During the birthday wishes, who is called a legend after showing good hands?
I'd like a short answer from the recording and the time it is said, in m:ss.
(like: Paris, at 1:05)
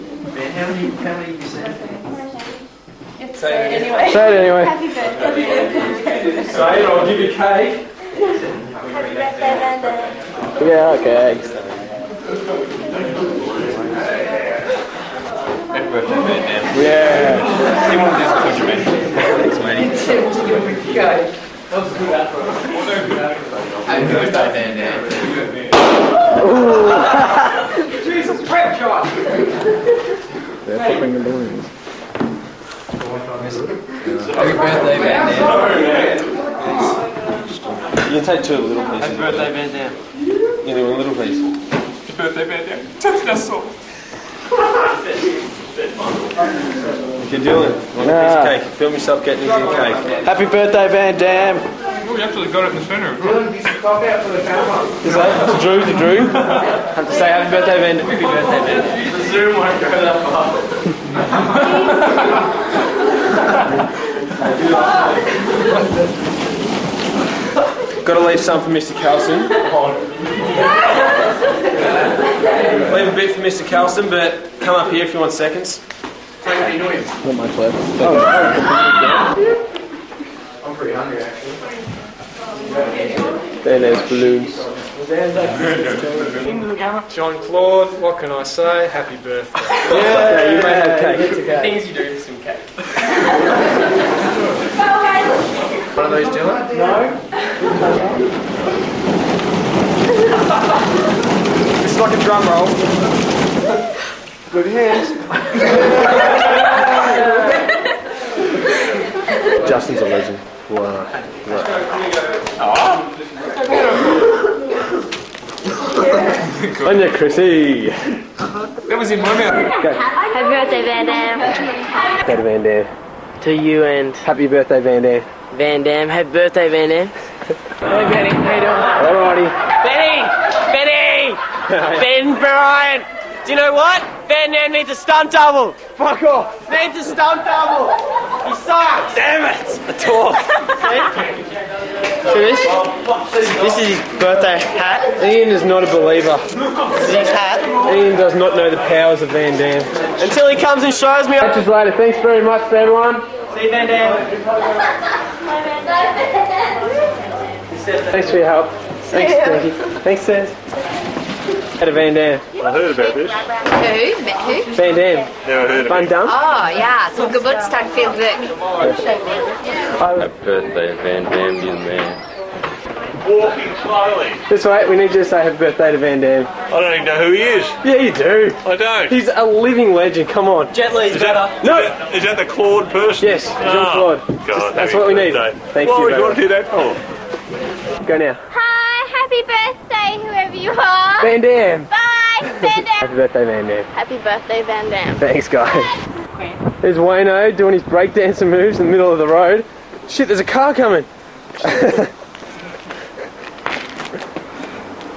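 Justin, at 1:49.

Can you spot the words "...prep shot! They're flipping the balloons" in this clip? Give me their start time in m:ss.
0:28.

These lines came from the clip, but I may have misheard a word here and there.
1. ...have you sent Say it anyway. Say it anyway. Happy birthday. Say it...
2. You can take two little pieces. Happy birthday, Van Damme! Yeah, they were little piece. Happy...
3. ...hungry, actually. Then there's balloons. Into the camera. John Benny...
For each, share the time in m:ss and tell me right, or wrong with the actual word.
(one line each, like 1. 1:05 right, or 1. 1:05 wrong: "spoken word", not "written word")
1. 0:01 right
2. 0:38 right
3. 1:20 wrong: "Claude", not "Benny".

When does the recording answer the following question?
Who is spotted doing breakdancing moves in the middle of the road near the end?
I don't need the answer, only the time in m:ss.
3:16.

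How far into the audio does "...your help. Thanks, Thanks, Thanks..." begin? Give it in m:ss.
2:38.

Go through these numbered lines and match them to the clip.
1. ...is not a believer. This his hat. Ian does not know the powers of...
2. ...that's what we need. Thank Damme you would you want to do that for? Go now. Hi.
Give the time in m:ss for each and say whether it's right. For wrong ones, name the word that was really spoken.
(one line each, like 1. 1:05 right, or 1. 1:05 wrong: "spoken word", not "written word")
1. 2:25 right
2. 3:04 wrong: "Why", not "Damme".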